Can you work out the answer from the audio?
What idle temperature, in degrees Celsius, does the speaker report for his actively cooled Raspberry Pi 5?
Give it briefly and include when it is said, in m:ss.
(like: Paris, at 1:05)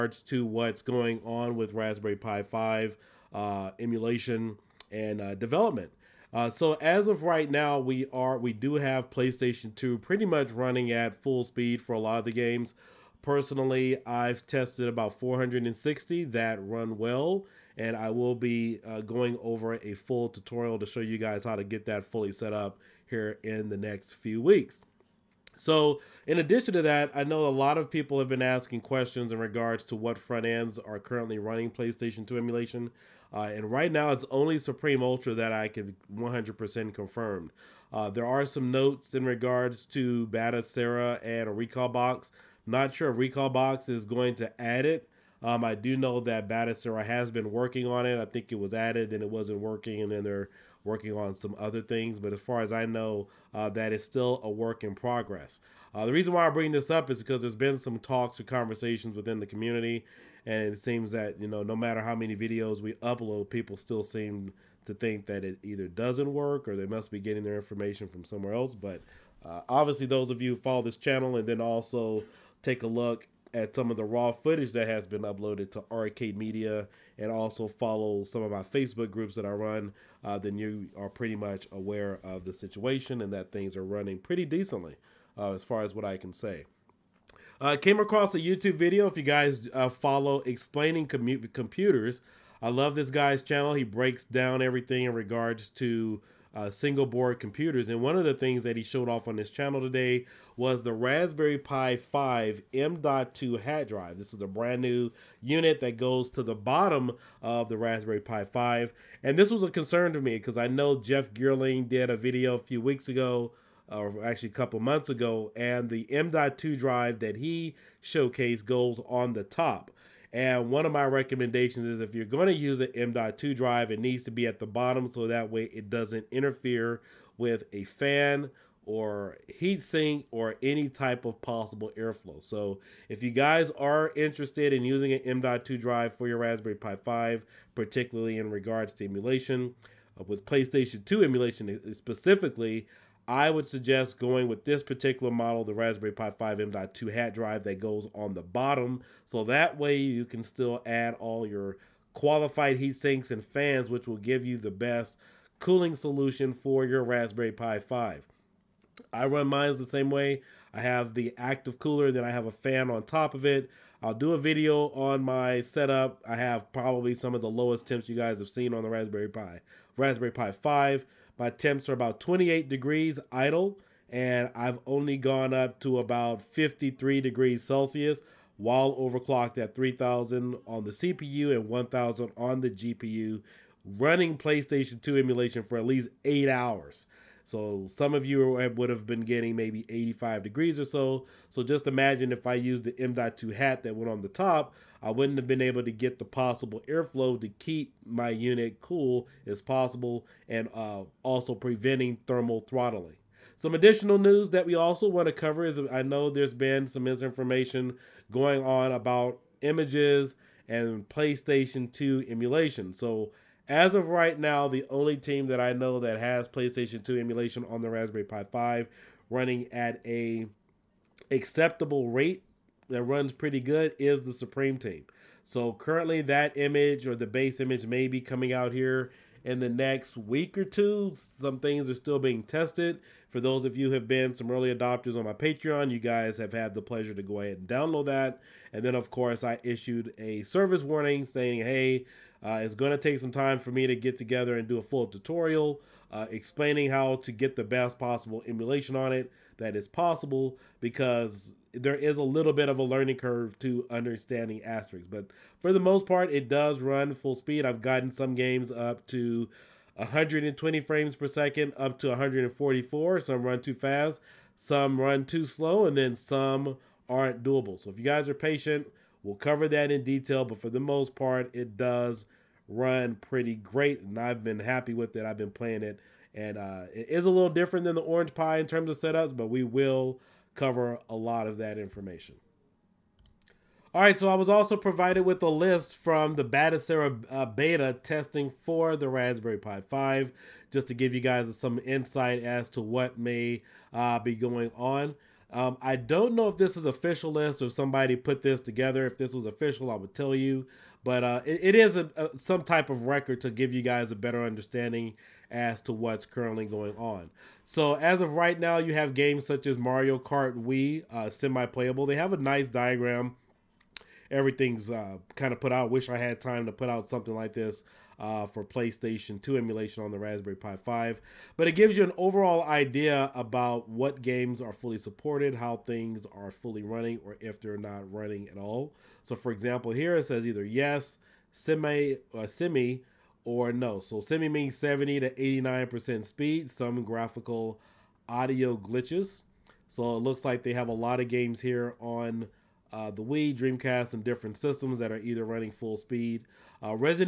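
28, at 2:52.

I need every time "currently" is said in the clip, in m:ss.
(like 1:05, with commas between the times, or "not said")
0:31, 3:45, 5:06.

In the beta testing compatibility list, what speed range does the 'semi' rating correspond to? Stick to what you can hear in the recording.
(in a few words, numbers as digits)
70 to 89%.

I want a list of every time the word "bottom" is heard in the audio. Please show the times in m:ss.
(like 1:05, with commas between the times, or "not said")
1:46, 2:04, 2:28.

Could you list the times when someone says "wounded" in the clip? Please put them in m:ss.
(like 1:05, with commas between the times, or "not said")
not said.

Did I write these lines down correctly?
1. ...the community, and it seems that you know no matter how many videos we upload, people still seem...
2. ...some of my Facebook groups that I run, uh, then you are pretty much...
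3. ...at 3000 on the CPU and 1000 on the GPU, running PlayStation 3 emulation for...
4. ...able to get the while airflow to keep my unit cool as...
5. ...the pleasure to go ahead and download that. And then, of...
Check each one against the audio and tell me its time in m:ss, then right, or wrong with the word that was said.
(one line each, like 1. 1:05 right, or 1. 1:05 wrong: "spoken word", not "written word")
1. 0:59 right
2. 1:18 right
3. 2:59 wrong: "2", not "3"
4. 3:15 wrong: "possible", not "while"
5. 3:56 right.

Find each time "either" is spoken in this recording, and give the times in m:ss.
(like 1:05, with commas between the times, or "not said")
1:05, 5:30, 5:45.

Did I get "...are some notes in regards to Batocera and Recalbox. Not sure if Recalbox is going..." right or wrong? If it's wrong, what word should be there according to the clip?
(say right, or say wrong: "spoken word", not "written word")
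right.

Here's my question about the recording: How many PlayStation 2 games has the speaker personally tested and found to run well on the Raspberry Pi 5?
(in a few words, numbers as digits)
460.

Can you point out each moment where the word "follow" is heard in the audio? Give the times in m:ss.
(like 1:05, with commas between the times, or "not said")
1:10, 1:17, 1:29.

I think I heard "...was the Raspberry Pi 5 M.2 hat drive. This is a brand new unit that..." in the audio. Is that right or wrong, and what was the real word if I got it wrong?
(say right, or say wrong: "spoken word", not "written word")
right.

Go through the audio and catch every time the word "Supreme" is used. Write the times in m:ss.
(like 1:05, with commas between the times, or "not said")
0:34, 3:44.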